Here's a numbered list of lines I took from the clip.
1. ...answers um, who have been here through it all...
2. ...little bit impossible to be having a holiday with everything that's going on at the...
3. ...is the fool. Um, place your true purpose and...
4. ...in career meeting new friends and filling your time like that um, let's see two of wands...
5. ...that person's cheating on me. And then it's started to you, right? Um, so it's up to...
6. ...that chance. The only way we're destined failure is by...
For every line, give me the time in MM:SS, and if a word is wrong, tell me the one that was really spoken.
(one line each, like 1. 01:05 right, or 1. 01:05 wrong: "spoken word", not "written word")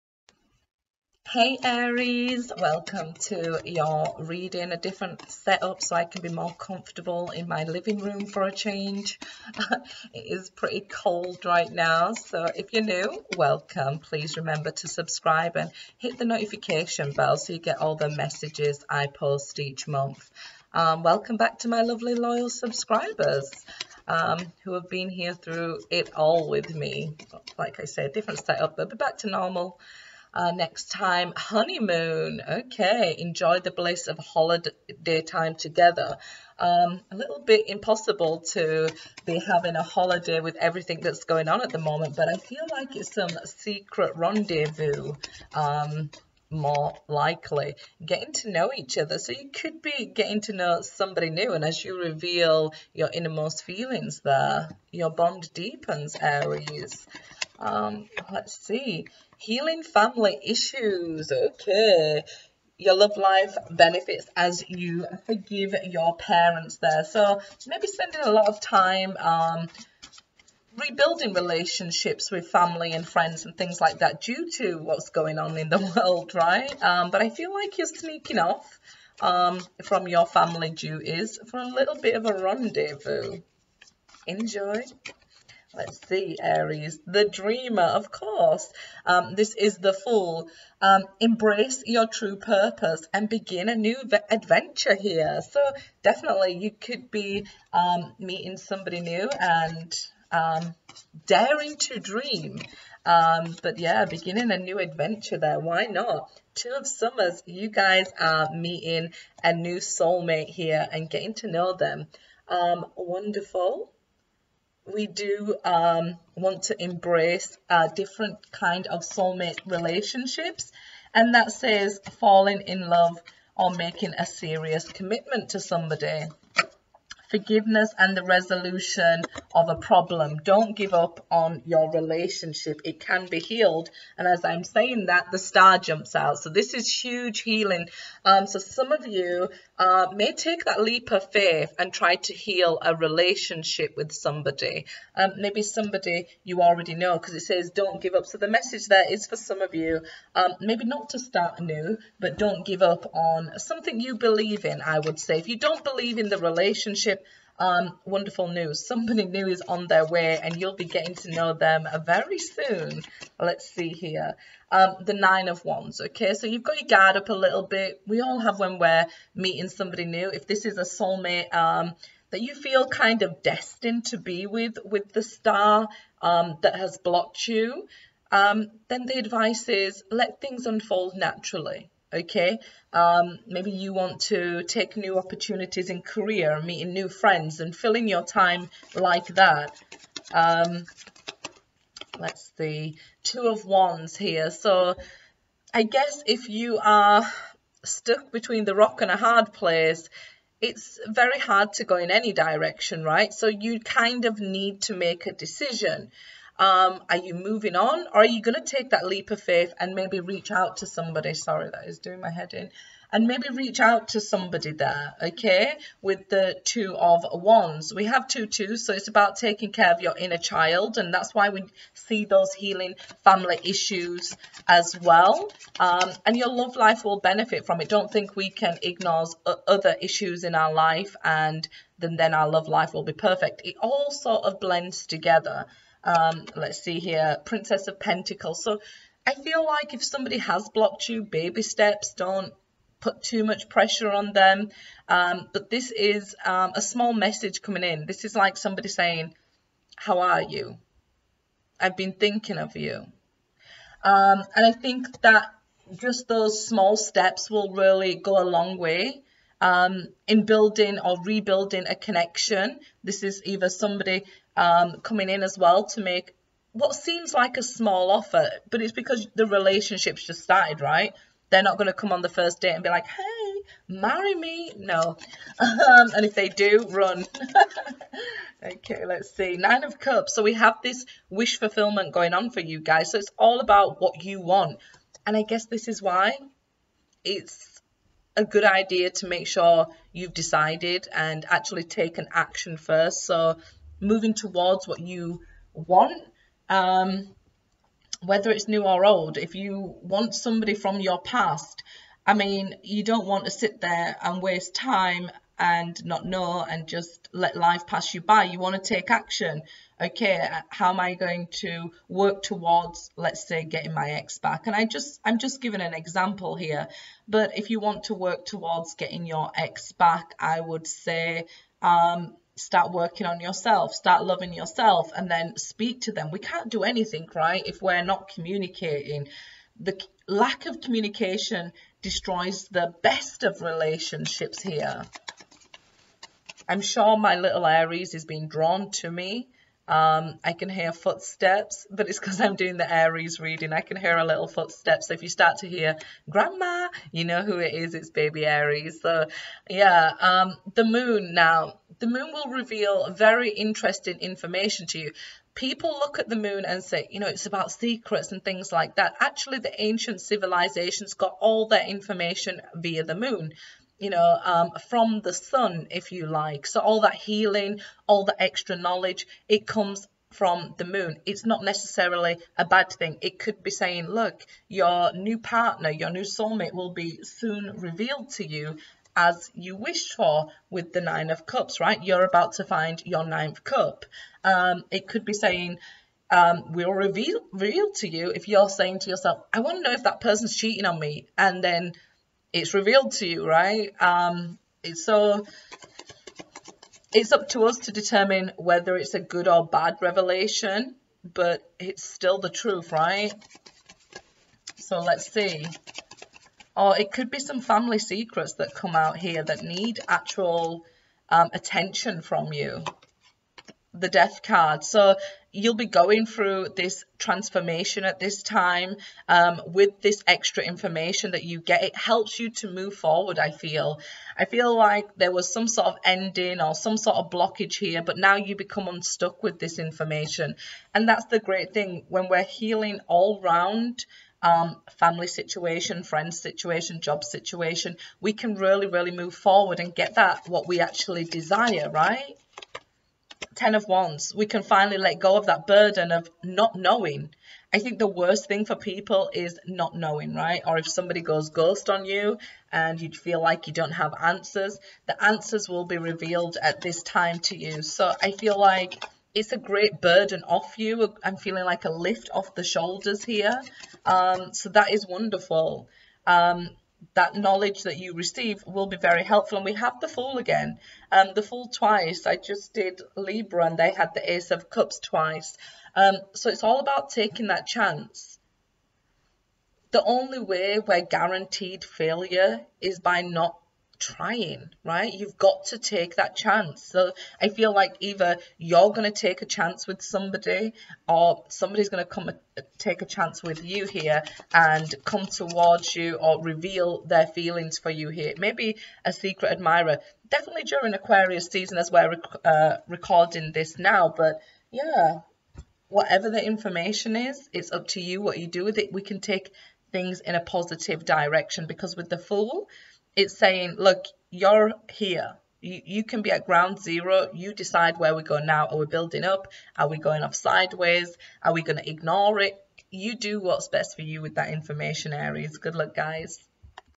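1. 00:22 wrong: "subscribers", not "answers"
2. 00:37 right
3. 01:29 wrong: "embrace", not "place"
4. 03:05 right
5. 06:30 wrong: "revealed", not "started"
6. 07:57 wrong: "guaranteed", not "destined".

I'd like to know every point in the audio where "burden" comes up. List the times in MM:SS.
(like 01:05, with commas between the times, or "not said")
07:25, 07:40.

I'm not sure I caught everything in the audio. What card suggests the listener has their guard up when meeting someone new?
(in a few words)
Nine of Wands.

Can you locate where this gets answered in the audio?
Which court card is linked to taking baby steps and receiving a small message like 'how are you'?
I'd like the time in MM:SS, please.
03:57.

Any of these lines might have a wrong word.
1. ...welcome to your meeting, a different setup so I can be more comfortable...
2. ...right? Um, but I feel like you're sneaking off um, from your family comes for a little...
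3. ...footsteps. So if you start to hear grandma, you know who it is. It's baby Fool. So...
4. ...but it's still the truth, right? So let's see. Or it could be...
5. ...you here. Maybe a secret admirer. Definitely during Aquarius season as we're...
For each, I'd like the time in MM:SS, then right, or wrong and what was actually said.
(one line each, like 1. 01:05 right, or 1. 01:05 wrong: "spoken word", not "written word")
1. 00:02 wrong: "reading", not "meeting"
2. 01:16 wrong: "duties", not "comes"
3. 05:44 wrong: "Aries", not "Fool"
4. 06:41 right
5. 08:17 right.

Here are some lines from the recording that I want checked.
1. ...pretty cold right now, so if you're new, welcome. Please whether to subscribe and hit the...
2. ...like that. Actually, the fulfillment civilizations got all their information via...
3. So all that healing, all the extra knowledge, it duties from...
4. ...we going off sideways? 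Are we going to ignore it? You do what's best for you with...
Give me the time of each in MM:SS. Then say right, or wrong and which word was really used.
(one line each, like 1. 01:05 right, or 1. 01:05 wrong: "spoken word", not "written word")
1. 00:10 wrong: "remember", not "whether"
2. 05:58 wrong: "ancient", not "fulfillment"
3. 06:06 wrong: "comes", not "duties"
4. 08:39 right.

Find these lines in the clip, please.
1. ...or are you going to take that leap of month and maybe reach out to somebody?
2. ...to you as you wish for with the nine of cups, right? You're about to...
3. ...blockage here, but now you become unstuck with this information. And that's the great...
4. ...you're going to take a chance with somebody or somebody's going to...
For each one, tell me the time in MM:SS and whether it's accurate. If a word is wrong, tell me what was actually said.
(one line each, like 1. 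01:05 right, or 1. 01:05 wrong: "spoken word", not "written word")
1. 03:28 wrong: "faith", not "month"
2. 06:18 right
3. 07:07 right
4. 08:08 right.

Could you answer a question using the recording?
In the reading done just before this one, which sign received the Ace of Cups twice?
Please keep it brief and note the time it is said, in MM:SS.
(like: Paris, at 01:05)
Libra, at 07:53.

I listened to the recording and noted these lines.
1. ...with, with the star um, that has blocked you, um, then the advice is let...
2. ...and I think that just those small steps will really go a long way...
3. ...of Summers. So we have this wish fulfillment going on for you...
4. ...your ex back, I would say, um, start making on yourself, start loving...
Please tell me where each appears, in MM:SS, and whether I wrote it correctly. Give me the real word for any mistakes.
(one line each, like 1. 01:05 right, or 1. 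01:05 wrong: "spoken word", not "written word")
1. 02:54 right
2. 04:14 right
3. 04:39 wrong: "Cups", not "Summers"
4. 05:19 wrong: "working", not "making".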